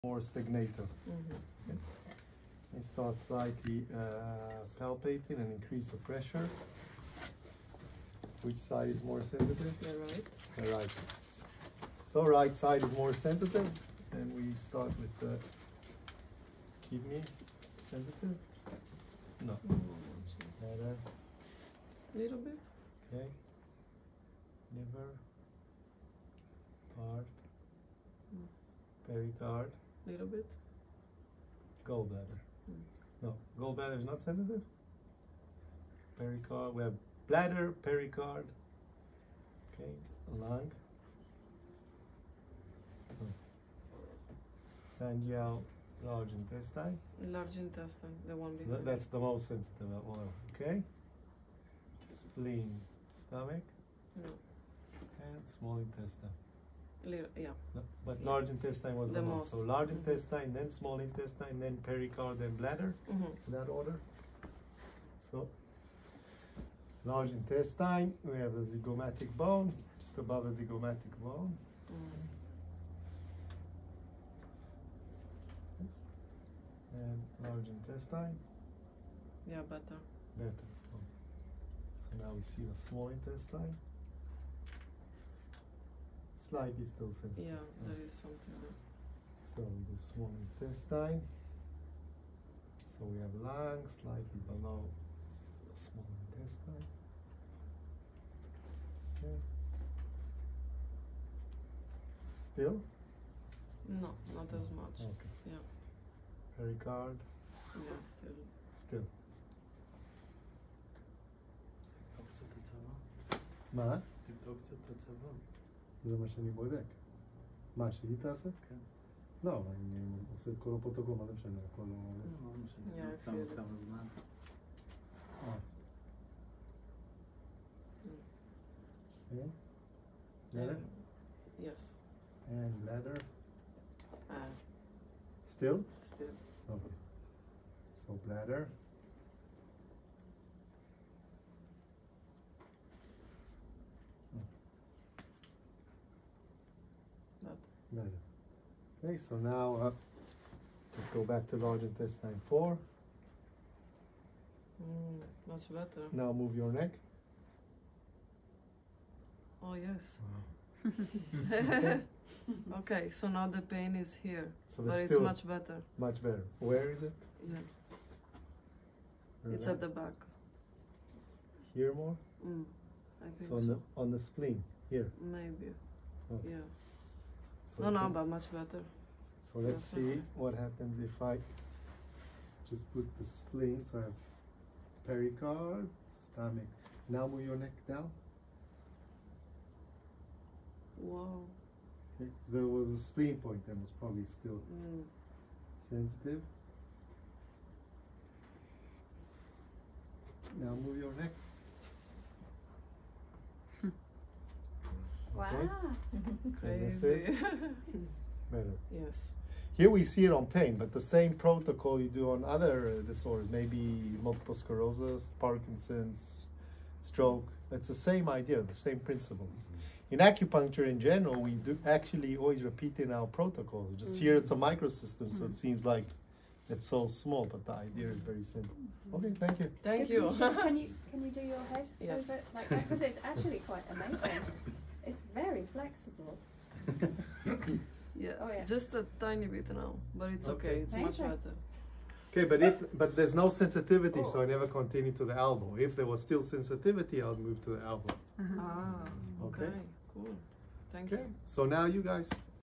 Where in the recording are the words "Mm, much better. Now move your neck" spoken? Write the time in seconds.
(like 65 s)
154 s.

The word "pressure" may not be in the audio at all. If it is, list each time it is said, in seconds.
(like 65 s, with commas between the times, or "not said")
5 s.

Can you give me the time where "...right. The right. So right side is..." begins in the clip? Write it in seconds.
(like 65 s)
9 s.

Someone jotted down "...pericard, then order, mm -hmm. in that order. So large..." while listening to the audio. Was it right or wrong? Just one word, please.
wrong.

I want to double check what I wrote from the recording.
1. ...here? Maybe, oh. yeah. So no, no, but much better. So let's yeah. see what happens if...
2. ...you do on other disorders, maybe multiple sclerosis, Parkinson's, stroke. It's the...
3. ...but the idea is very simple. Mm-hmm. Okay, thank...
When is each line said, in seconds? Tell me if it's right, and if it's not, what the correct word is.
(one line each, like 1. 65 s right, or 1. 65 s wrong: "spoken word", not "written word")
1. 174 s right
2. 211 s right
3. 227 s right.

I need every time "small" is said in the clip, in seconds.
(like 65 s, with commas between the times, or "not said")
55 s, 60 s, 82 s, 90 s, 95 s, 227 s.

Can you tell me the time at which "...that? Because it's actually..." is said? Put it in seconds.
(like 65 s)
232 s.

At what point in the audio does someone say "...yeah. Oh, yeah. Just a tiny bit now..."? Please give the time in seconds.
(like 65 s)
238 s.